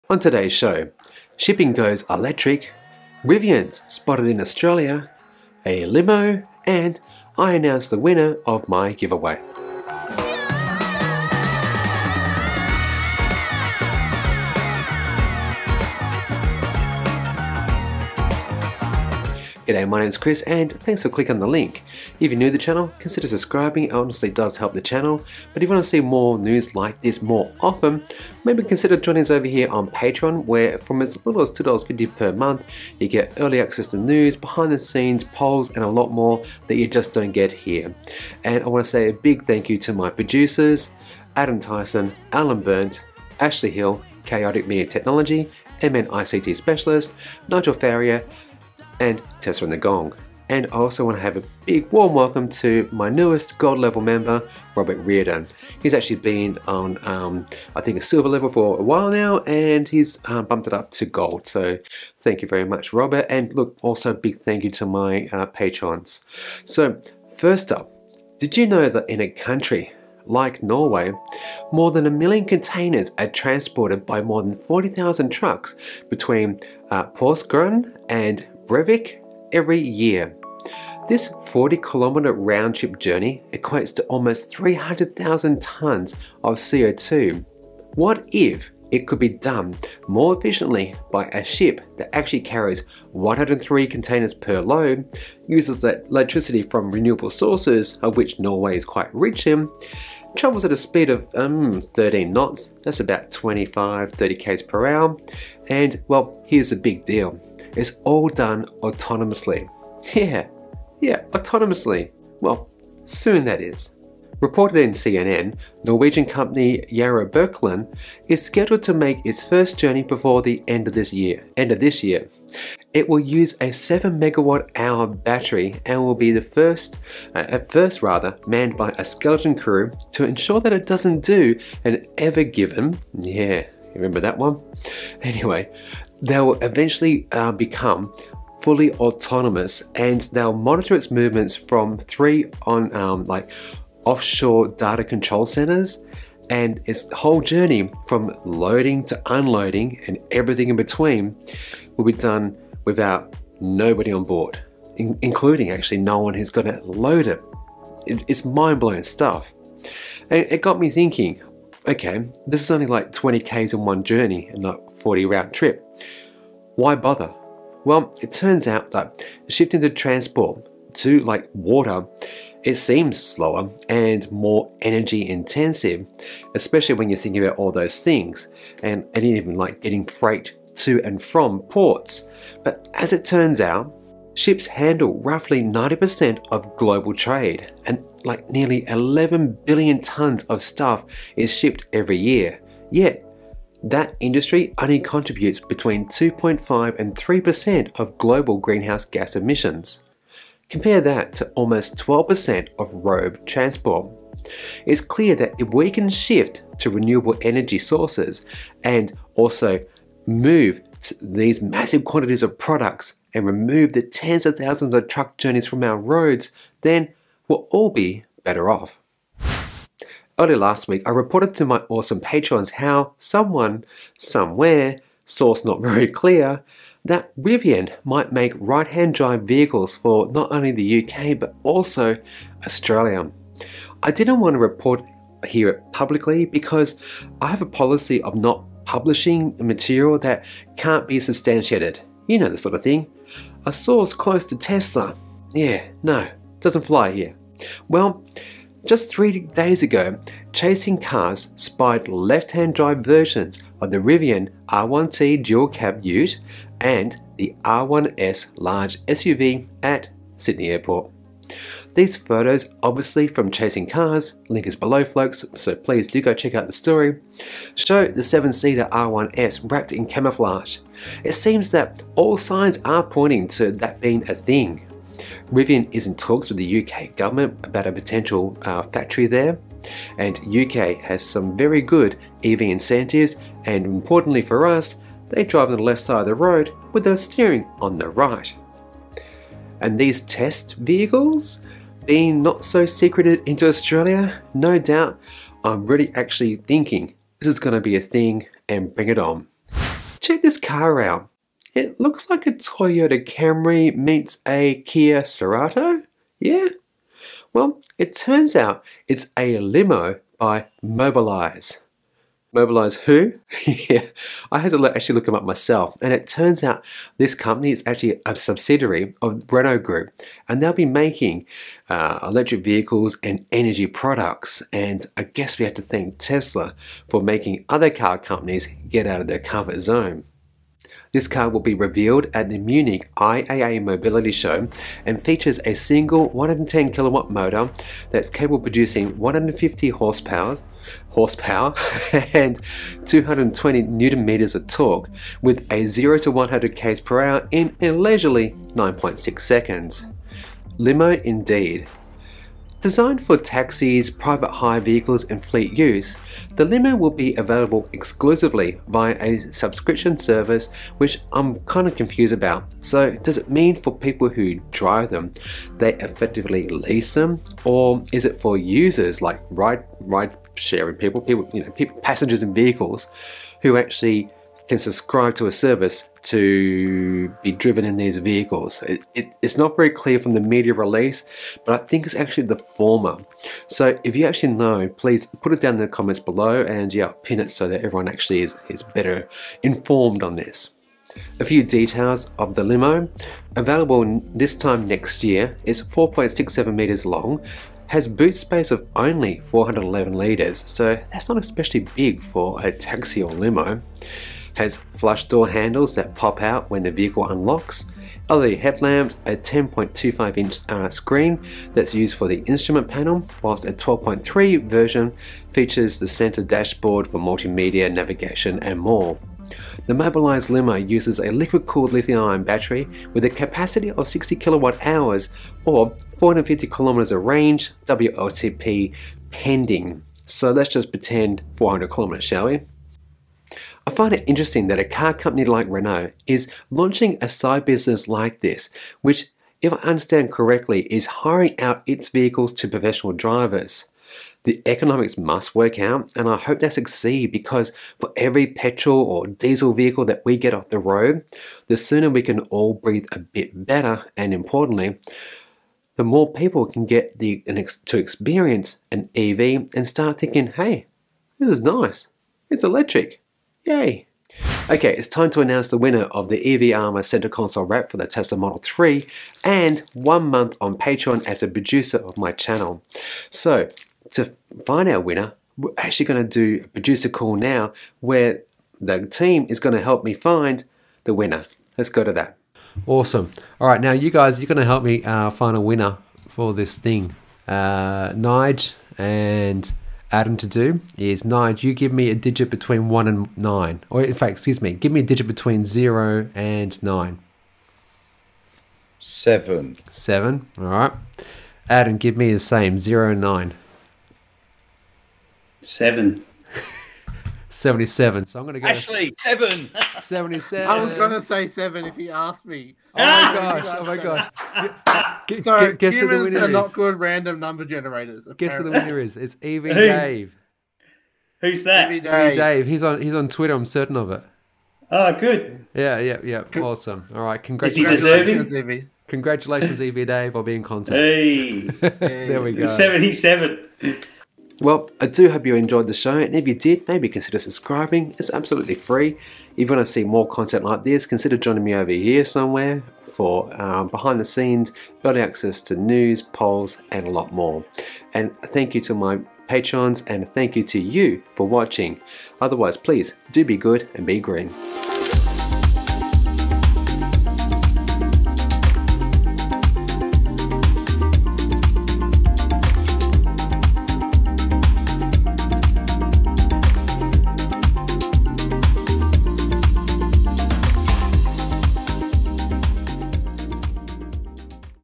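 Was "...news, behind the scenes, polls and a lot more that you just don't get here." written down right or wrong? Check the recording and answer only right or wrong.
right.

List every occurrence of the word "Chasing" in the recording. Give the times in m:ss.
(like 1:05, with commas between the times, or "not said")
4:10, 4:23.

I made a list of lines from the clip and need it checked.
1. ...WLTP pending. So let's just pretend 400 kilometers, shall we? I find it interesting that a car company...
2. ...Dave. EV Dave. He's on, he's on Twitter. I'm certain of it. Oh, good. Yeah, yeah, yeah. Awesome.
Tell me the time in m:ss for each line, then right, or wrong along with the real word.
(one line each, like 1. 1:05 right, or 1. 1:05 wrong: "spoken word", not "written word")
1. 7:07 right
2. 8:42 right.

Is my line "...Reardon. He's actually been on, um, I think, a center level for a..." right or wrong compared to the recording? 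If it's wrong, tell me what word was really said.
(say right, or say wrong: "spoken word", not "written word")
wrong: "silver", not "center".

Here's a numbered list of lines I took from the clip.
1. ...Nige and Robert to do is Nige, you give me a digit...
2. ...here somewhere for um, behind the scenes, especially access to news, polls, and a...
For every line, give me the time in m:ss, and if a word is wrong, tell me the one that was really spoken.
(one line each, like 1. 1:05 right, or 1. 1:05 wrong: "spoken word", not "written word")
1. 8:08 wrong: "Adam", not "Robert"
2. 9:01 wrong: "early", not "especially".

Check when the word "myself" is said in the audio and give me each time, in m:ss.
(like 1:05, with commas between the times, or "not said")
5:15.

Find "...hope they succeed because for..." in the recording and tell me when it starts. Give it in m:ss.
7:26.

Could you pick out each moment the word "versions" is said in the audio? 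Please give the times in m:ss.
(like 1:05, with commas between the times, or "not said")
4:13, 6:54.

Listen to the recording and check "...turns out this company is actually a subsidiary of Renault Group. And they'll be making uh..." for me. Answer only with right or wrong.
right.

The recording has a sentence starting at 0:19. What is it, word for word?
G'day, my name's Chris and thanks for clicking the link.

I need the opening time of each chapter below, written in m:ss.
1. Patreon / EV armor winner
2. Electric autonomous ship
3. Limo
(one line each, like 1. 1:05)
1. 7:44
2. 1:06
3. 4:59.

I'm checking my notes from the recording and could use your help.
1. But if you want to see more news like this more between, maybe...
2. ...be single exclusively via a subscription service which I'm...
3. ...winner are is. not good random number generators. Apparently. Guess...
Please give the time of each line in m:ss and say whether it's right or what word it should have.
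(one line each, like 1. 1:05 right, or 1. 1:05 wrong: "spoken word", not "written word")
1. 0:25 wrong: "often", not "between"
2. 5:57 wrong: "available", not "single"
3. 8:36 right.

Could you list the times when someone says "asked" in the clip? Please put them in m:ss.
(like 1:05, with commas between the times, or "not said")
8:32.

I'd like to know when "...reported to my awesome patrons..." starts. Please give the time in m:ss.
3:41.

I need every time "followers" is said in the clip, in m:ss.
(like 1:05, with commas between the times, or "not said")
not said.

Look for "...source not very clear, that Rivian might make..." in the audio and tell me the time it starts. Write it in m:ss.
3:45.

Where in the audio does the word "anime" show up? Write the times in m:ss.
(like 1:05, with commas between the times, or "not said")
not said.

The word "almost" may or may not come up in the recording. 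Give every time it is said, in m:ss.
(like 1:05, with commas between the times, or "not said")
1:24, 3:21.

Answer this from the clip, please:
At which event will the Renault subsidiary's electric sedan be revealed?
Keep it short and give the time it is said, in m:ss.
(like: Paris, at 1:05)
Munich IAA Mobility Show, at 5:32.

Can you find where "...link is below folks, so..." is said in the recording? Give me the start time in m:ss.
4:24.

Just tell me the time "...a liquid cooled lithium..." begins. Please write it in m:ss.
7:01.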